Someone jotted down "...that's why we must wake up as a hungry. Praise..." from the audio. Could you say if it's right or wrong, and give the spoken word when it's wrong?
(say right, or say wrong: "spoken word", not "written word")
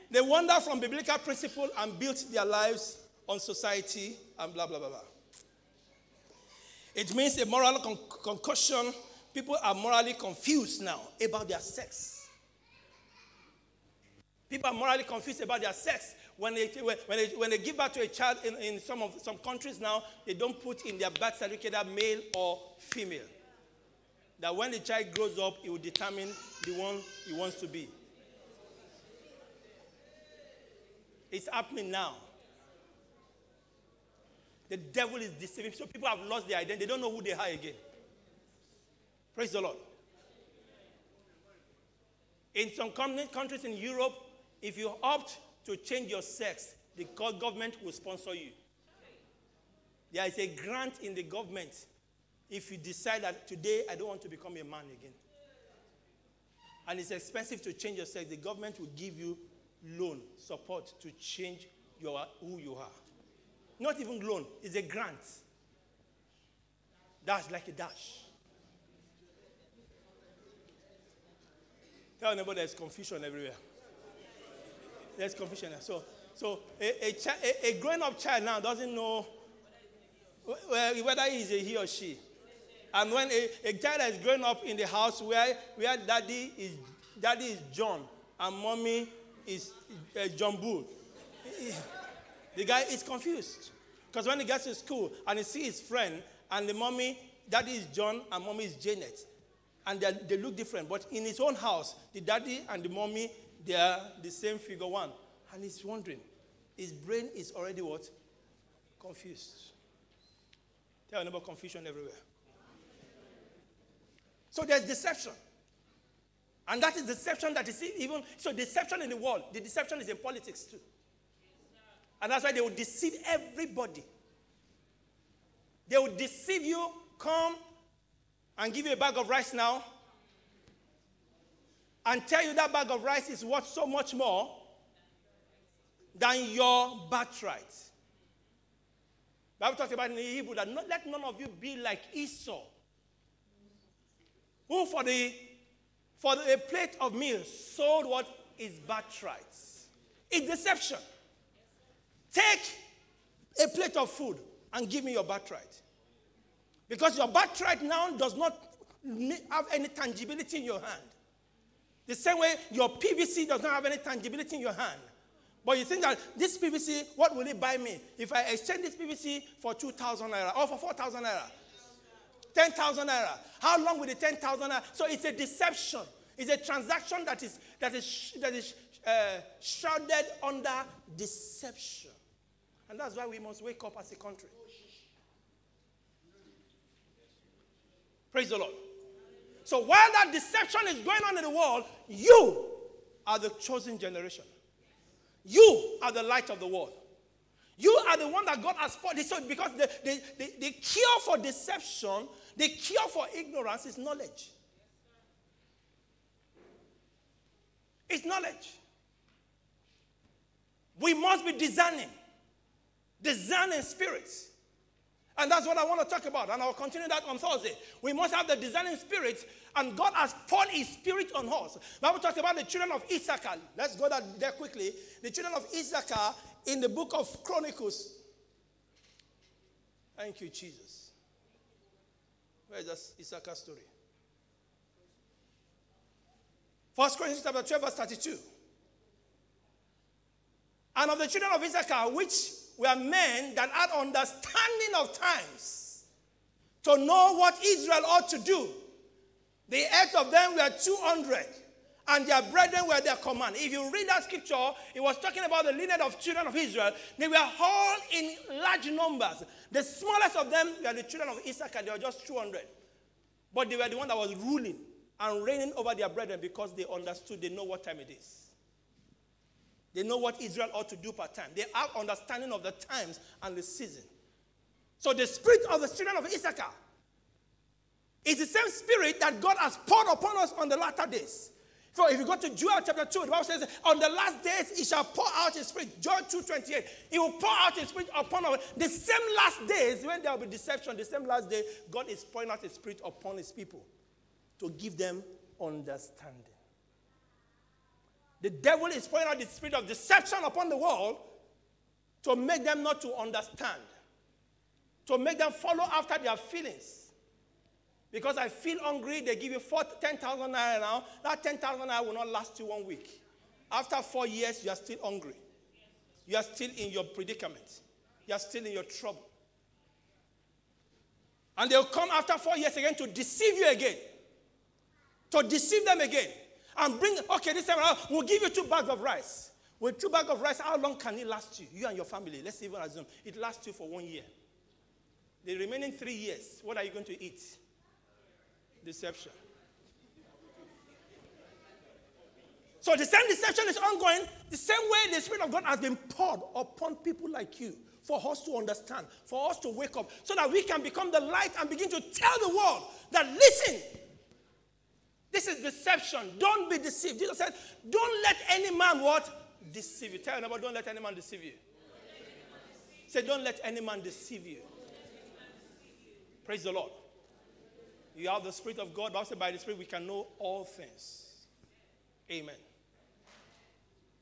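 wrong: "country", not "hungry".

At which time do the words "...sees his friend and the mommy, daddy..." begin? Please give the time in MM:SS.
01:35.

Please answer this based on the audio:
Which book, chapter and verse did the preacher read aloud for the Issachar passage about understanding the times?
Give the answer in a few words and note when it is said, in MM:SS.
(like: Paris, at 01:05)
1 Corinthians 12:32, at 03:56.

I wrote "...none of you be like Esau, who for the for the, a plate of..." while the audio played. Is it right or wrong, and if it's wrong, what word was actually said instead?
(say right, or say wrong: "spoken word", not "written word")
right.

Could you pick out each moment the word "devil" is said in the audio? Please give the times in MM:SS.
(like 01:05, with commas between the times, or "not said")
00:34, 04:58.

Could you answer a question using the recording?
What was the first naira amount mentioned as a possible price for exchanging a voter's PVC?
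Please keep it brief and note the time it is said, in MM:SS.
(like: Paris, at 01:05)
2,000 naira, at 02:49.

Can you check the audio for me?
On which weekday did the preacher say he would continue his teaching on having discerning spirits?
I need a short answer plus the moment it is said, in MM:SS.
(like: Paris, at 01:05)
Thursday, at 03:37.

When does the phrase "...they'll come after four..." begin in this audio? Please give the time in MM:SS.
05:21.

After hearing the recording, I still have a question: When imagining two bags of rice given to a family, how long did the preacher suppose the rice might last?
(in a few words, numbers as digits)
1 year.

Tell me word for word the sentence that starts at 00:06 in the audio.
It means a moral con- concussion.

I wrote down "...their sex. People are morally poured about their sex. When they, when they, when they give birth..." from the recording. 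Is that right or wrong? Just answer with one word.
wrong.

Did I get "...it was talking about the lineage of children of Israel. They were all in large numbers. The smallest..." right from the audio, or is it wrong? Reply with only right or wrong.
right.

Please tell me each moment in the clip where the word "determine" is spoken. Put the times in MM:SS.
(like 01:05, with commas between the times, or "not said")
00:25.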